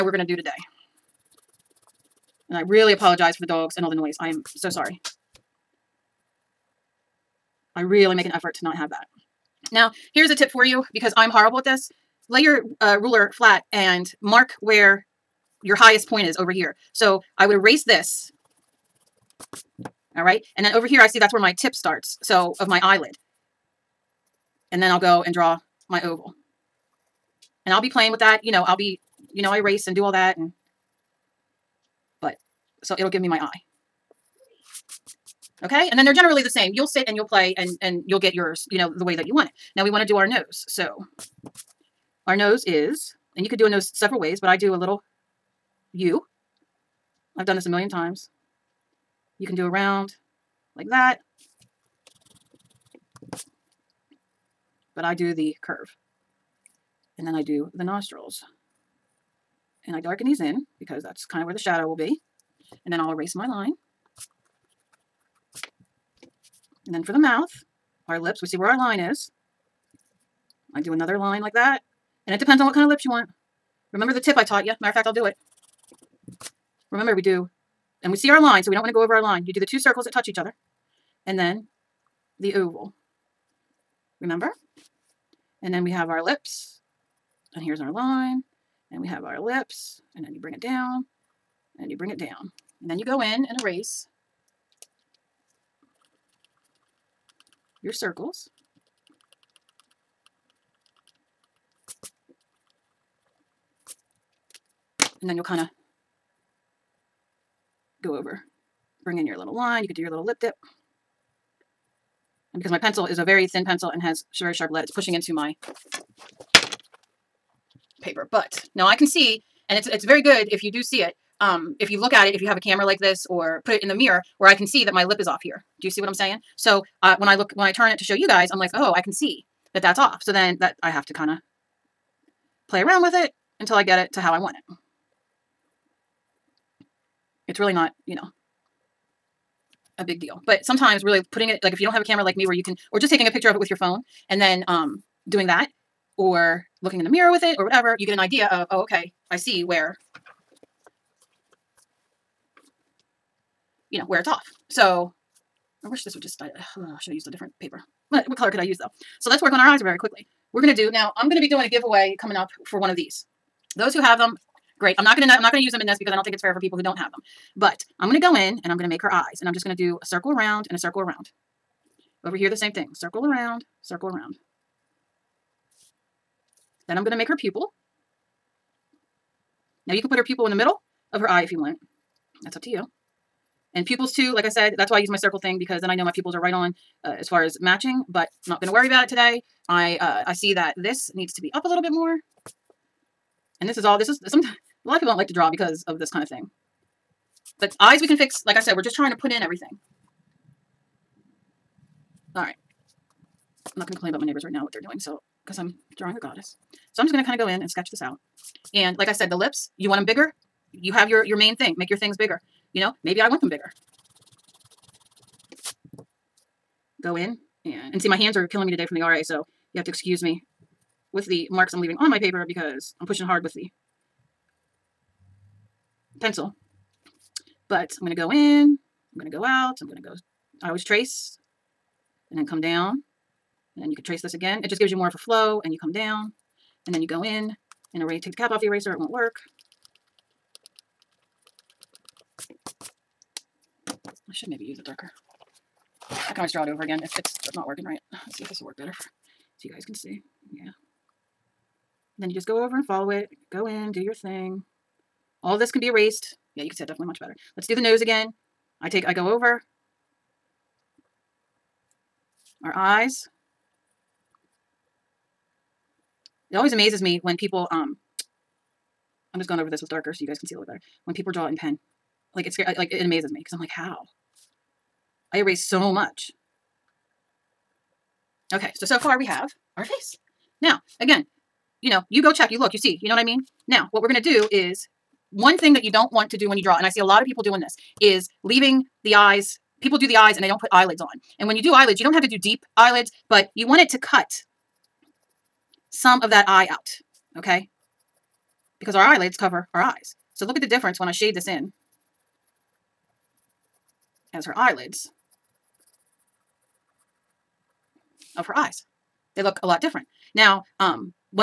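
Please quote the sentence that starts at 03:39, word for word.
So you have to excuse me with the marks I'm leaving on my paper because I'm pushing hard with the pencil.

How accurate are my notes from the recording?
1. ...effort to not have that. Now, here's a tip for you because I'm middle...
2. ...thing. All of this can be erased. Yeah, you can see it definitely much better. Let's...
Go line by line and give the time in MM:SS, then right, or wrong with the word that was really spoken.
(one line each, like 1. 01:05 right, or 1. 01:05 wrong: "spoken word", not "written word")
1. 00:08 wrong: "horrible", not "middle"
2. 04:14 right.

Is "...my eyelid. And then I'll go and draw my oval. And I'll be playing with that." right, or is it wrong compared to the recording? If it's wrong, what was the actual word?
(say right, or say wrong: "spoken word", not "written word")
right.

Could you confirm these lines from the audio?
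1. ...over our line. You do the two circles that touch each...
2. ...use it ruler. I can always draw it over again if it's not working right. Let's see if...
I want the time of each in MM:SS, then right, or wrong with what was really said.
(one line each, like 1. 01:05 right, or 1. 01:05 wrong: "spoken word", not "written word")
1. 01:19 right
2. 04:04 wrong: "darker", not "ruler".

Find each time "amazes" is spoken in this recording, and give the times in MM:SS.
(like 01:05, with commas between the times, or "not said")
04:26, 04:33.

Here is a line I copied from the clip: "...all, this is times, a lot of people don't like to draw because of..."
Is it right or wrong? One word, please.
wrong.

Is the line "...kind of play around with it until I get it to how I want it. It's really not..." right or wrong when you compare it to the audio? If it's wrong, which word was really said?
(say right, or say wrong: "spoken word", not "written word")
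right.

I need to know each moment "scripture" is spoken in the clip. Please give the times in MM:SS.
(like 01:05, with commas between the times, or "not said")
not said.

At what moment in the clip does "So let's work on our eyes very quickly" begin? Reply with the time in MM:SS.
02:39.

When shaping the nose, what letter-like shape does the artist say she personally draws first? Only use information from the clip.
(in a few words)
U.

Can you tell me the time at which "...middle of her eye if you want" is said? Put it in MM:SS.
03:00.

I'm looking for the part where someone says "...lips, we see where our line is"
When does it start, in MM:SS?
01:08.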